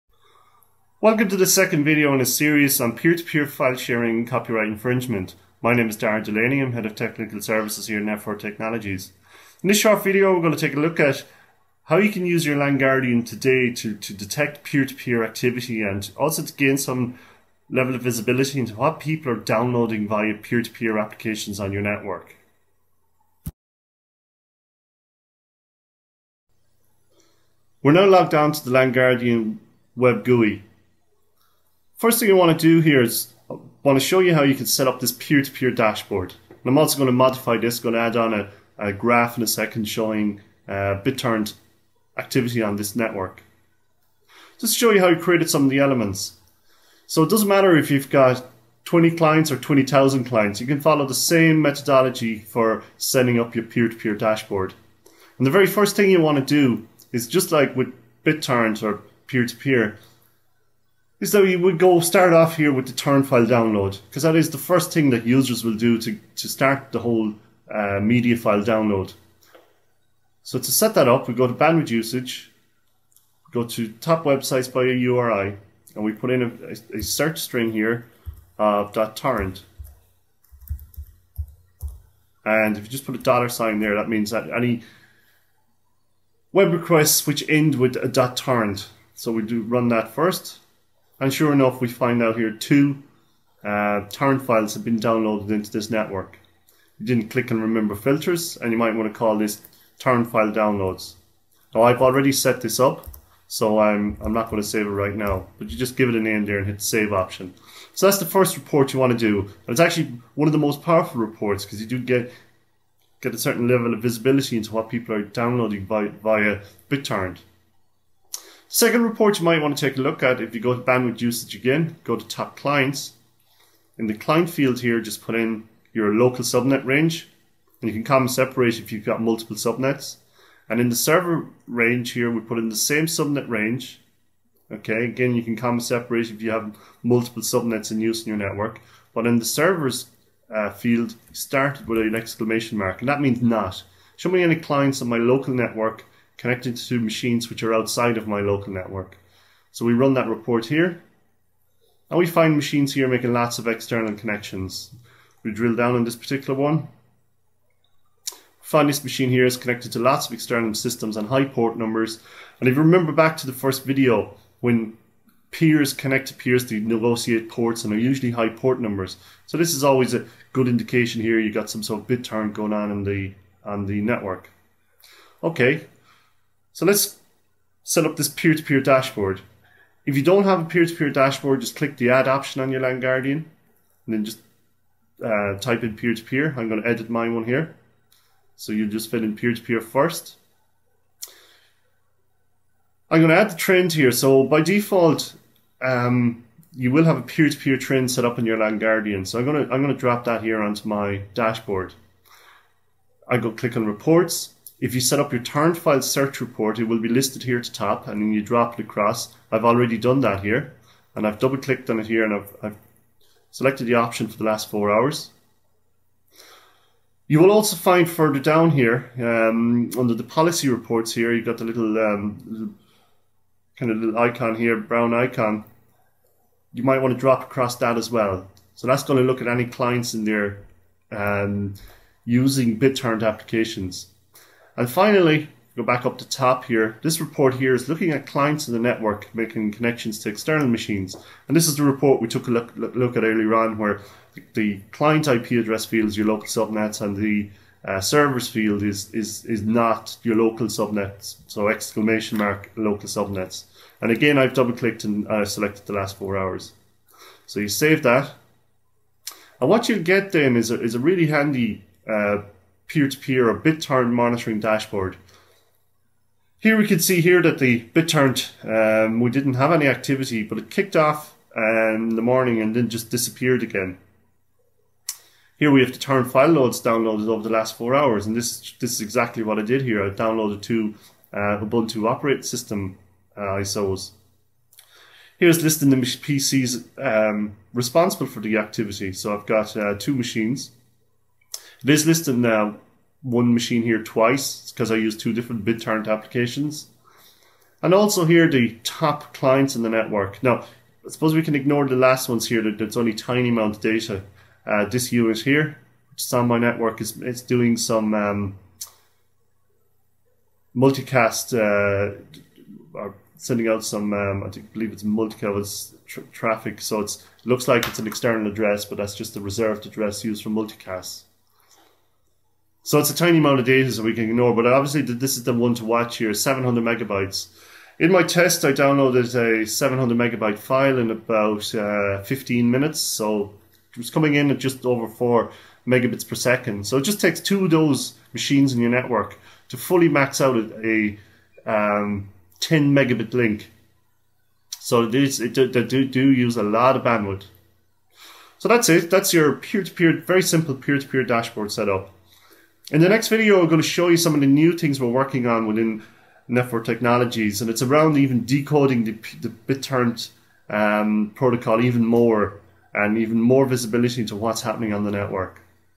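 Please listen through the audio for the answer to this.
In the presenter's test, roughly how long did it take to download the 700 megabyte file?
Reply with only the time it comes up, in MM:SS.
05:32.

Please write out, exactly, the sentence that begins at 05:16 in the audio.
So it looks like it's an external address, but that's just the reserved address used for multicast.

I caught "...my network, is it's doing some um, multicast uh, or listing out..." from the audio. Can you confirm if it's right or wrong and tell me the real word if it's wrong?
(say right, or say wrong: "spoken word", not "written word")
wrong: "sending", not "listing".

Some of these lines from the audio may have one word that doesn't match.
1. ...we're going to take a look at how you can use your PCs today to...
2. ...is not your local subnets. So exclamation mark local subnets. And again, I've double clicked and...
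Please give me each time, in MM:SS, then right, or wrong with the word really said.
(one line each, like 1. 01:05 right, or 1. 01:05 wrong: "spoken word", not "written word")
1. 00:10 wrong: "LANGuardian", not "PCs"
2. 04:09 right.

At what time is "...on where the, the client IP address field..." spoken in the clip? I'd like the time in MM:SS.
04:03.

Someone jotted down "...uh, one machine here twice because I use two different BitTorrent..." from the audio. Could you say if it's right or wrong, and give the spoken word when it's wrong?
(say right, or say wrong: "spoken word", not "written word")
right.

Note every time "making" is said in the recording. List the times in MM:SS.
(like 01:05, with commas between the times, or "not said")
02:33, 03:59.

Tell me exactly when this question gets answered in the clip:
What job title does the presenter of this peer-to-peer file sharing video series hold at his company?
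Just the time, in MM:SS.
00:06.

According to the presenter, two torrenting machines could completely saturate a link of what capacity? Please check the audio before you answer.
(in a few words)
10 megabit.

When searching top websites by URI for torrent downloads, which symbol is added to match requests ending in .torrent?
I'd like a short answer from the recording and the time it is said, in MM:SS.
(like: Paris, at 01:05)
dollar sign, at 01:23.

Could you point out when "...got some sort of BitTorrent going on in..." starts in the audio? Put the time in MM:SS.
02:51.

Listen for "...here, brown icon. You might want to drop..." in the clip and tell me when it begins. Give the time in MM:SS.
03:44.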